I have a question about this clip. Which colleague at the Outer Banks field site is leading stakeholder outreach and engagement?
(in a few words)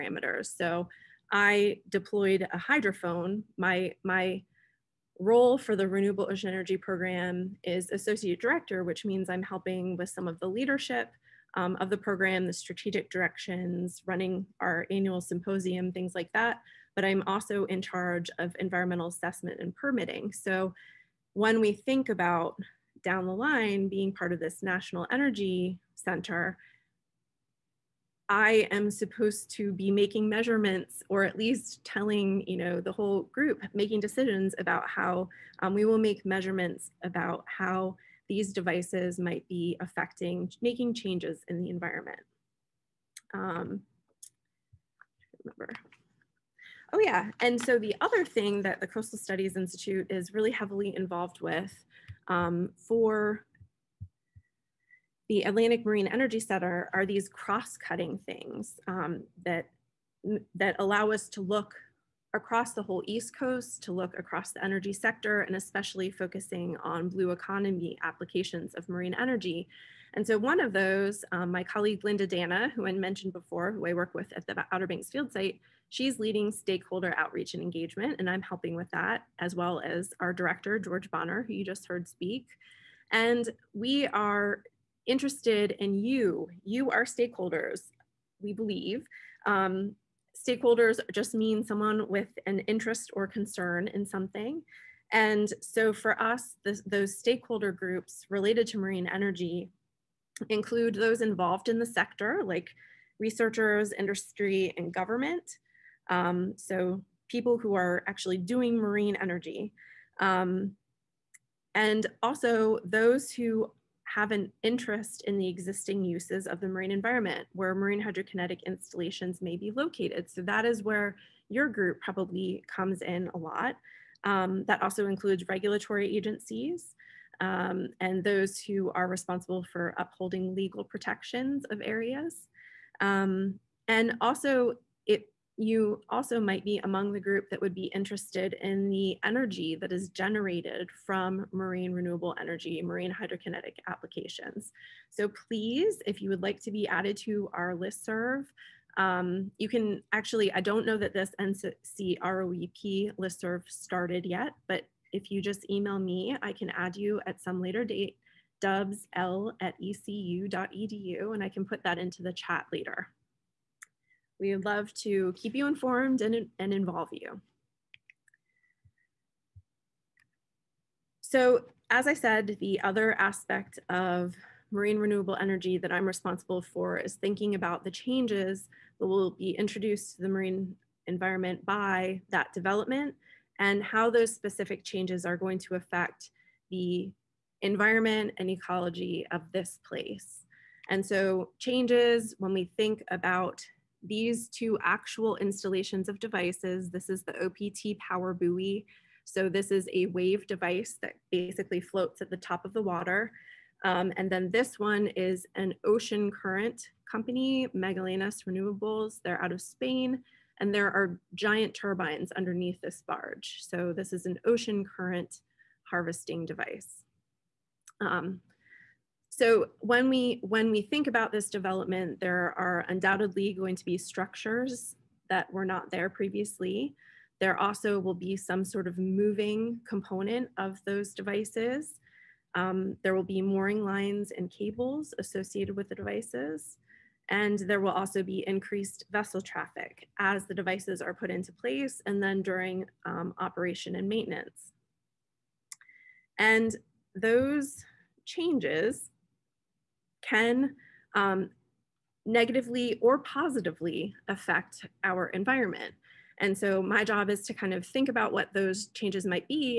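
Linda D'Anna.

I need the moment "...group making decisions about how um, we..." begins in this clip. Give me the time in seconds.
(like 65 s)
33 s.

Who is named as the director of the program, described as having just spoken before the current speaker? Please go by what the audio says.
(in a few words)
George Bonner.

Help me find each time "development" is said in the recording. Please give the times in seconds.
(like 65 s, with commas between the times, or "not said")
182 s, 221 s.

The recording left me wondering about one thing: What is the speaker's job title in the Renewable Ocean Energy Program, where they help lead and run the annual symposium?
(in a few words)
Associate Director.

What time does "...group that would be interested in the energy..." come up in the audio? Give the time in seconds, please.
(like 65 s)
137 s.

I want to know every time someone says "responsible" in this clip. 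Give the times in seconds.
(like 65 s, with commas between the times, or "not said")
129 s, 176 s.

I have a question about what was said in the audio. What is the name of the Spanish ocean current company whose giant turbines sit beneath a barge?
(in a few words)
Magallanes Renewables.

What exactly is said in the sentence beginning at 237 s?
And there will also be increased vessel traffic as the devices are put into place and then during um, operation and maintenance.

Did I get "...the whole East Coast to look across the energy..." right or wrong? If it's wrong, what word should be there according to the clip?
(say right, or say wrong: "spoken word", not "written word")
right.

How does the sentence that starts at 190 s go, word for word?
And so changes when we think about these two actual installations of devices.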